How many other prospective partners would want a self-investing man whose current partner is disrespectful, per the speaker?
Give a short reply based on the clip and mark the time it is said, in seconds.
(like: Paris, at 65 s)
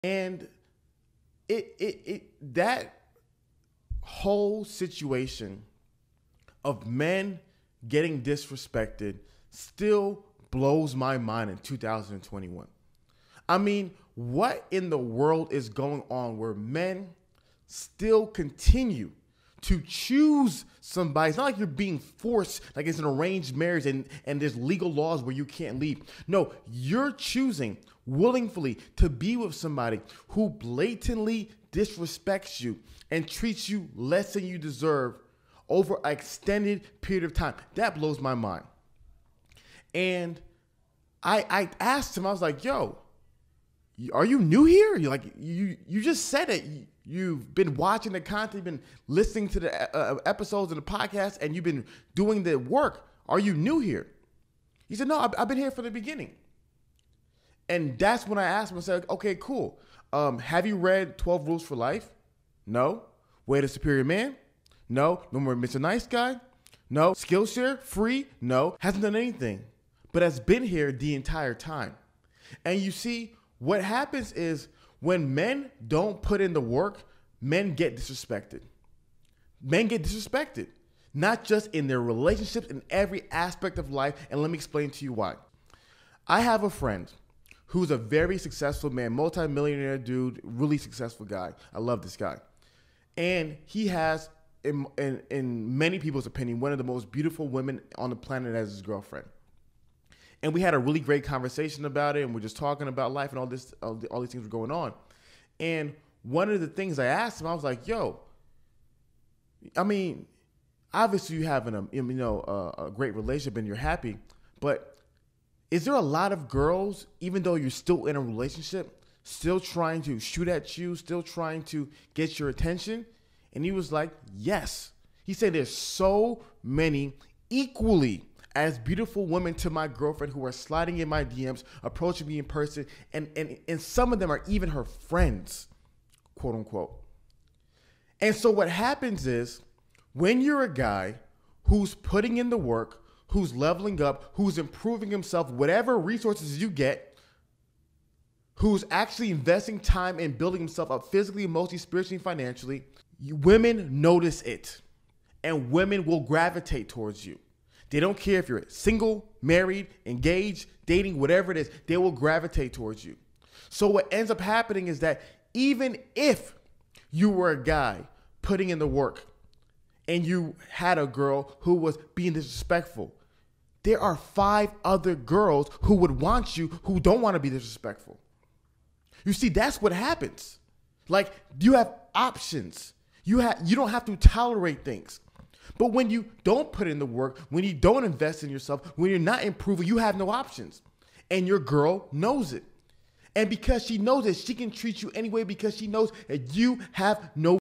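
5, at 174 s.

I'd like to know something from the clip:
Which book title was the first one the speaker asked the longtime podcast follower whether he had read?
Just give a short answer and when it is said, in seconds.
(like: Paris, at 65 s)
12 Rules for Life, at 61 s.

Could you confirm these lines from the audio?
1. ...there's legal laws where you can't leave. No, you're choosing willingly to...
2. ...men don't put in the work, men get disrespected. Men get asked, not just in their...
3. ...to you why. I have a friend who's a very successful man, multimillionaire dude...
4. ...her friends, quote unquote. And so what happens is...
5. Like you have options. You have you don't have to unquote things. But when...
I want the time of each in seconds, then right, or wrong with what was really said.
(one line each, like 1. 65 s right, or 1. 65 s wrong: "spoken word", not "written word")
1. 24 s right
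2. 75 s wrong: "disrespected", not "asked"
3. 84 s right
4. 134 s right
5. 181 s wrong: "tolerate", not "unquote".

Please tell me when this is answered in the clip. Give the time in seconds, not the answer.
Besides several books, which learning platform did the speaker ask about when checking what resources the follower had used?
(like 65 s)
67 s.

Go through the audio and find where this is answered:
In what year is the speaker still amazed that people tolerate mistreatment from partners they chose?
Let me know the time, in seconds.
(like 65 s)
11 s.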